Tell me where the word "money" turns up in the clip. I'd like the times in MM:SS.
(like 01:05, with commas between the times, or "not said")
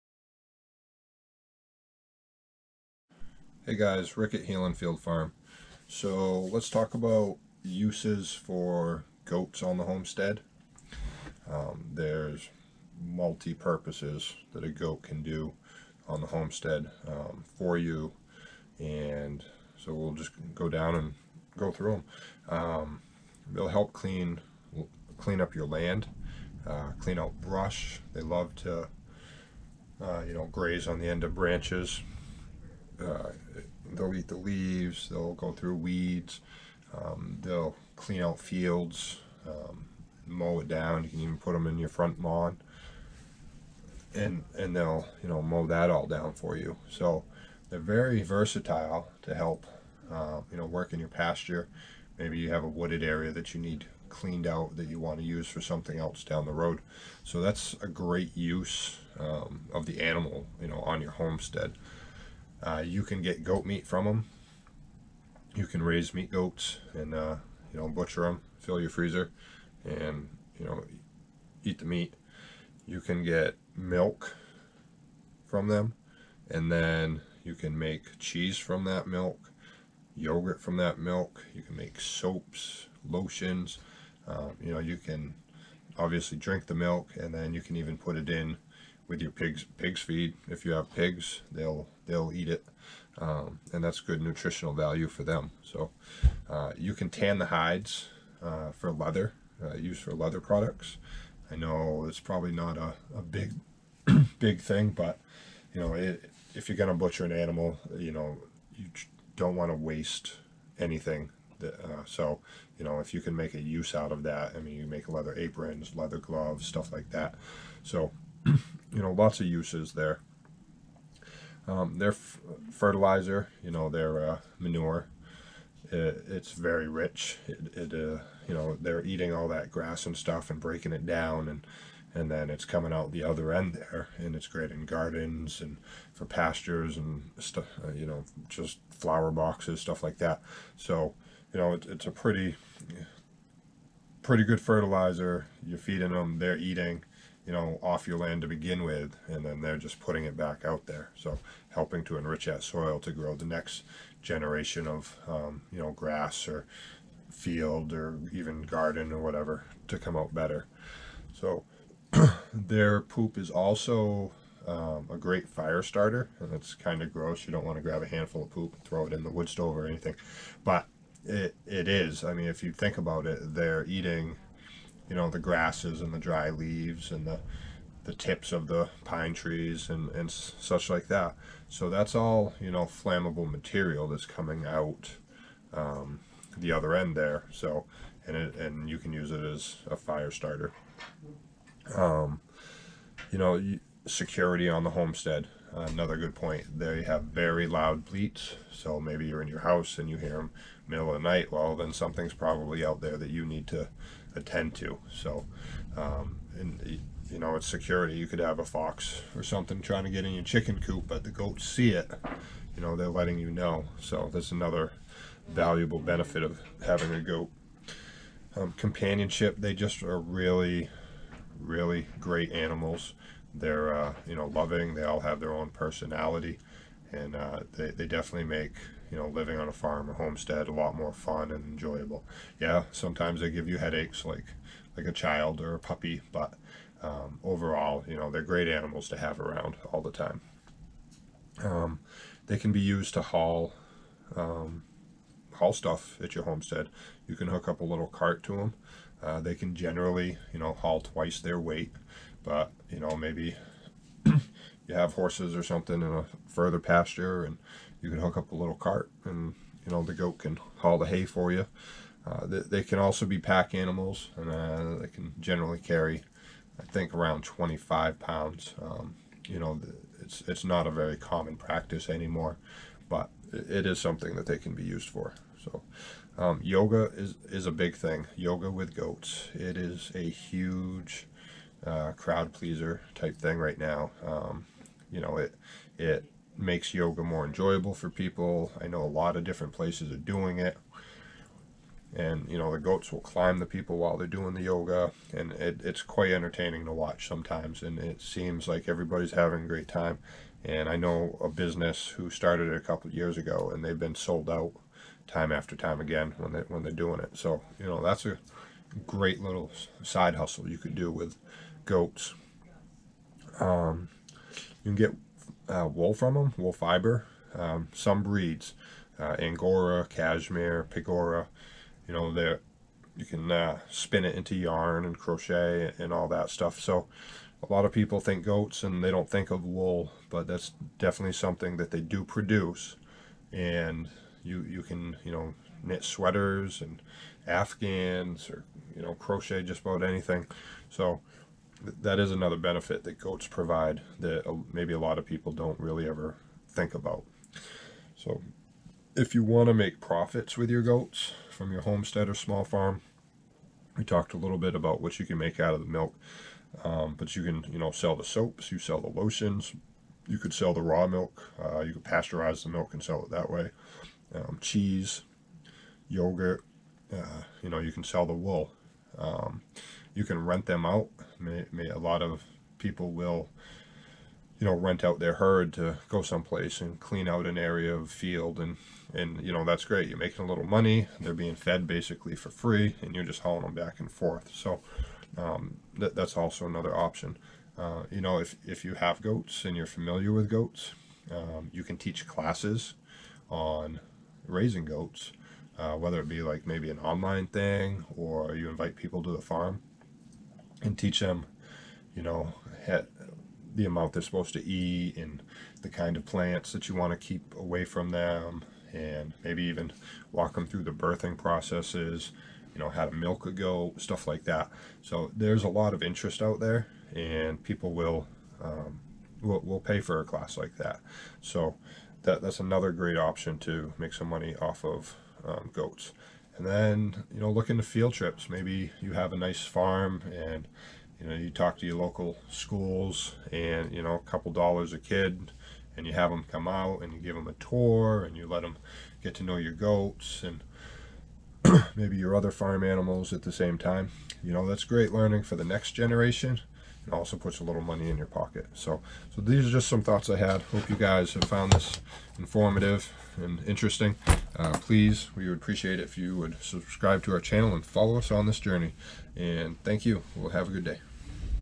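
06:20, 07:04, 07:27.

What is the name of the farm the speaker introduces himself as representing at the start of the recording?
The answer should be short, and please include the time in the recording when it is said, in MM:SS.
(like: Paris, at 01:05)
Healing Field Farm, at 00:04.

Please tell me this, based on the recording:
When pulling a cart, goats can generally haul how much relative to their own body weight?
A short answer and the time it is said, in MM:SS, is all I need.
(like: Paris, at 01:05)
Twice their weight, at 04:11.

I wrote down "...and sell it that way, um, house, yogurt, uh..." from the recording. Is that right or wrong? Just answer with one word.
wrong.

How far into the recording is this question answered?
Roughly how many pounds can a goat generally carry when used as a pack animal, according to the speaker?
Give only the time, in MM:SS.
04:27.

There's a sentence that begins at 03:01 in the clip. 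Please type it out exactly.
So that's all, you know, flammable material that's coming out um, the other end there.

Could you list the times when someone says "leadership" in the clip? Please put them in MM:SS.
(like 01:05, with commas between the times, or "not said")
not said.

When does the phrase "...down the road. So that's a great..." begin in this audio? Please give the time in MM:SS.
00:56.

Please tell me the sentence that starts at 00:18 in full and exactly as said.
And so we'll just go down and go through them.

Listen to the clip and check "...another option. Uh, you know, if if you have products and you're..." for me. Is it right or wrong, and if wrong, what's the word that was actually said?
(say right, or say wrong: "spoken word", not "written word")
wrong: "goats", not "products".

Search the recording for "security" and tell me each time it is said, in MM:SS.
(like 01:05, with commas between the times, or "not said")
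03:14, 03:27.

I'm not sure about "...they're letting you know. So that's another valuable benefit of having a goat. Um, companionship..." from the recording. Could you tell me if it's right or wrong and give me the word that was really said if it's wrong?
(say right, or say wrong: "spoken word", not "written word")
right.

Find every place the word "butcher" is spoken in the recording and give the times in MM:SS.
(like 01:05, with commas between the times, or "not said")
01:07, 01:46.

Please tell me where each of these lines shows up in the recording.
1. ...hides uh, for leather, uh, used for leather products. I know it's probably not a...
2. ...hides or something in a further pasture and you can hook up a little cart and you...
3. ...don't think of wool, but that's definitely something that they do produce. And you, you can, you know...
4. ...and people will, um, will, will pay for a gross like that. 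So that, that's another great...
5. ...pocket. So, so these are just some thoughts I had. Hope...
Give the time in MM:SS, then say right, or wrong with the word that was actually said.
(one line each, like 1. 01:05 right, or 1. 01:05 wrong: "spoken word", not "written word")
1. 01:37 right
2. 04:15 wrong: "horses", not "hides"
3. 05:29 right
4. 06:57 wrong: "class", not "gross"
5. 07:28 right.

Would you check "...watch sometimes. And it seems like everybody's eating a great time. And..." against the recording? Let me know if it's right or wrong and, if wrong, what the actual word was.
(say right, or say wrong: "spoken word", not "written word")
wrong: "having", not "eating".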